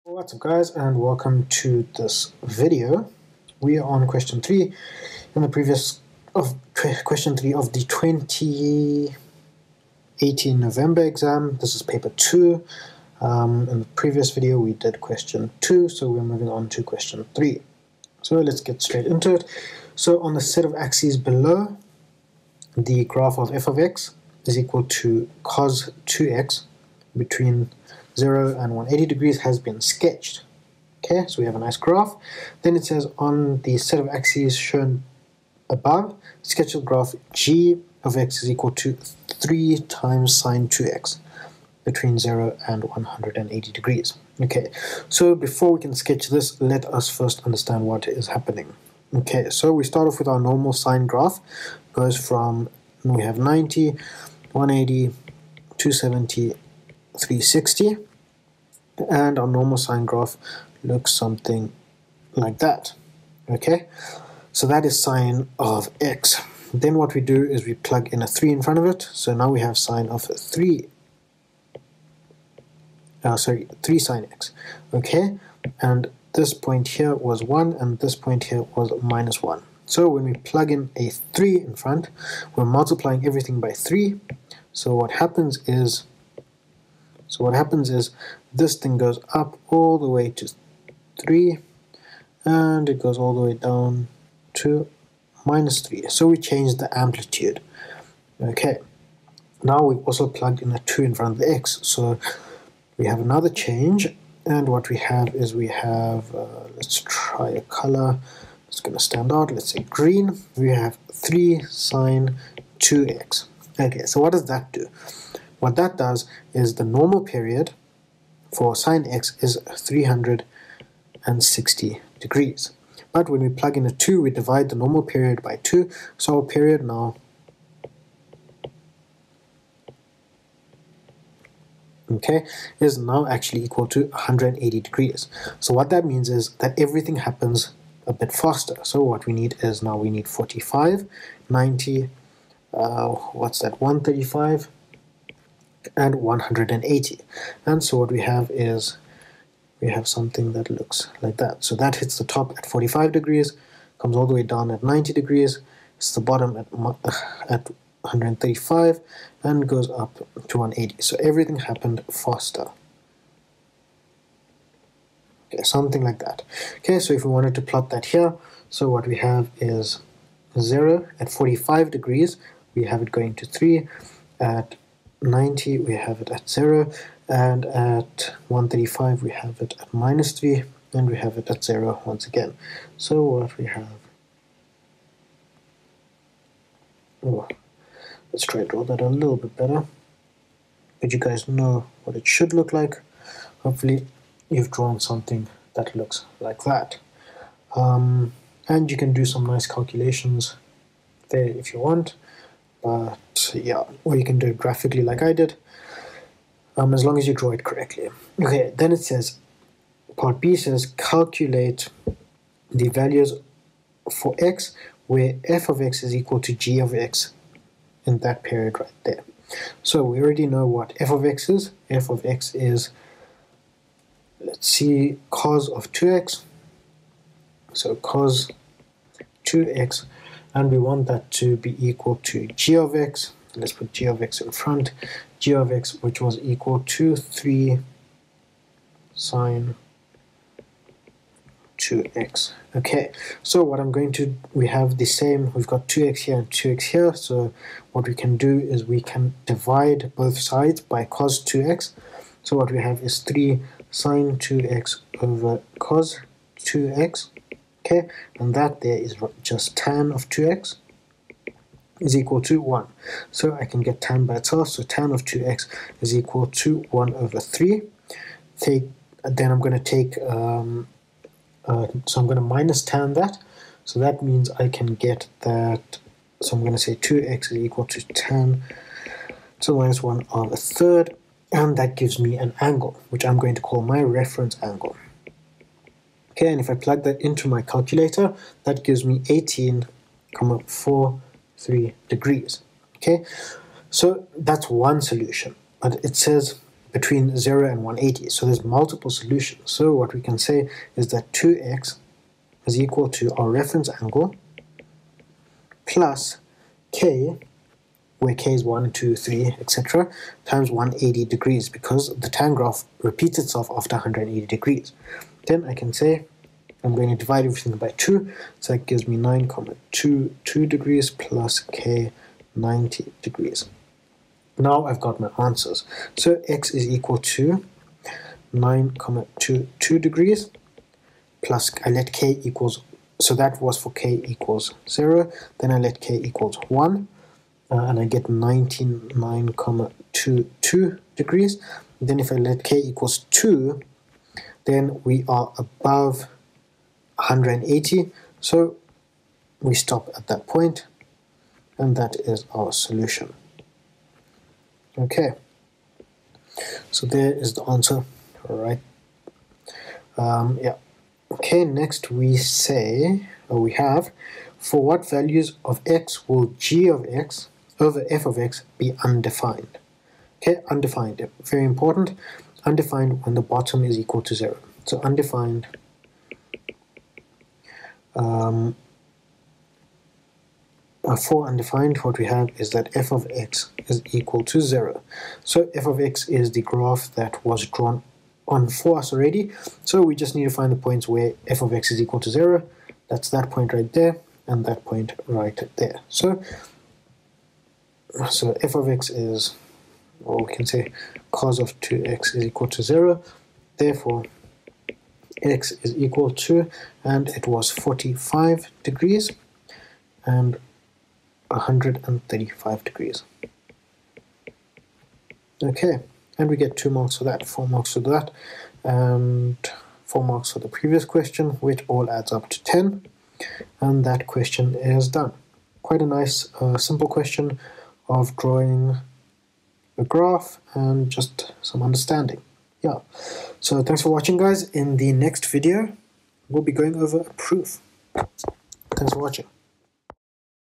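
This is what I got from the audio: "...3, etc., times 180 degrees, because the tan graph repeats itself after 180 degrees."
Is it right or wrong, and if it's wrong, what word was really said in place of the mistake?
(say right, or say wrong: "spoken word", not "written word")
right.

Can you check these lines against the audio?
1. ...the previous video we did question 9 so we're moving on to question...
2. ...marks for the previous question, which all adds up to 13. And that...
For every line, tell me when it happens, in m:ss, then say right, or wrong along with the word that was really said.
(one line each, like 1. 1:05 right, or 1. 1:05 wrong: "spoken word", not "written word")
1. 0:13 wrong: "2", not "9"
2. 7:00 wrong: "10", not "13".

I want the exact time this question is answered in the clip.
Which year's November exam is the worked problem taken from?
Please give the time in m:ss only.
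0:07.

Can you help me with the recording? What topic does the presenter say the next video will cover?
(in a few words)
A proof.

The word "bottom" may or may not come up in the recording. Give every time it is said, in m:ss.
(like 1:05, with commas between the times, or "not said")
2:36, 6:13.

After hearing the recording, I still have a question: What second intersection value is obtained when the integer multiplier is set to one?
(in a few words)
99.22 degrees.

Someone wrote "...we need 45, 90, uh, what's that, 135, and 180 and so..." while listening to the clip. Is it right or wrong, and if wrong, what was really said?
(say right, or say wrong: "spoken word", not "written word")
right.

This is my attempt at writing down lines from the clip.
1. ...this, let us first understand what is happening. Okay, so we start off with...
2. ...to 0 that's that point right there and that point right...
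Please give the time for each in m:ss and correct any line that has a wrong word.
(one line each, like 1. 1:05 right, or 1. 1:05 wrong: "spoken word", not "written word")
1. 0:46 right
2. 6:32 right.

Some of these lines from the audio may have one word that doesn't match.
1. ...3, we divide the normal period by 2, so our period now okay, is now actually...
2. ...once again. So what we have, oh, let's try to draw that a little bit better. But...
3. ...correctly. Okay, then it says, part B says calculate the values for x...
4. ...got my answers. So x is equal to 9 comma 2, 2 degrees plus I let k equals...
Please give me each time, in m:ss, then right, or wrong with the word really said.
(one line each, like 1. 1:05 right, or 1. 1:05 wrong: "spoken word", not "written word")
1. 2:03 wrong: "2", not "3"
2. 3:02 right
3. 3:27 right
4. 5:24 right.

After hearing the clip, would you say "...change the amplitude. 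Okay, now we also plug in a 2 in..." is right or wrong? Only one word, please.
right.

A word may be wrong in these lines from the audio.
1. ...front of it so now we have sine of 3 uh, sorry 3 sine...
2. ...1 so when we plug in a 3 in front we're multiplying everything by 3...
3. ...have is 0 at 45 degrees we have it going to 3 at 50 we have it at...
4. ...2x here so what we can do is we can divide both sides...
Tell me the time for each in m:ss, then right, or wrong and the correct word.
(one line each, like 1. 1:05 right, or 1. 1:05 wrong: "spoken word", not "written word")
1. 1:08 right
2. 1:19 right
3. 2:49 wrong: "90", not "50"
4. 4:06 right.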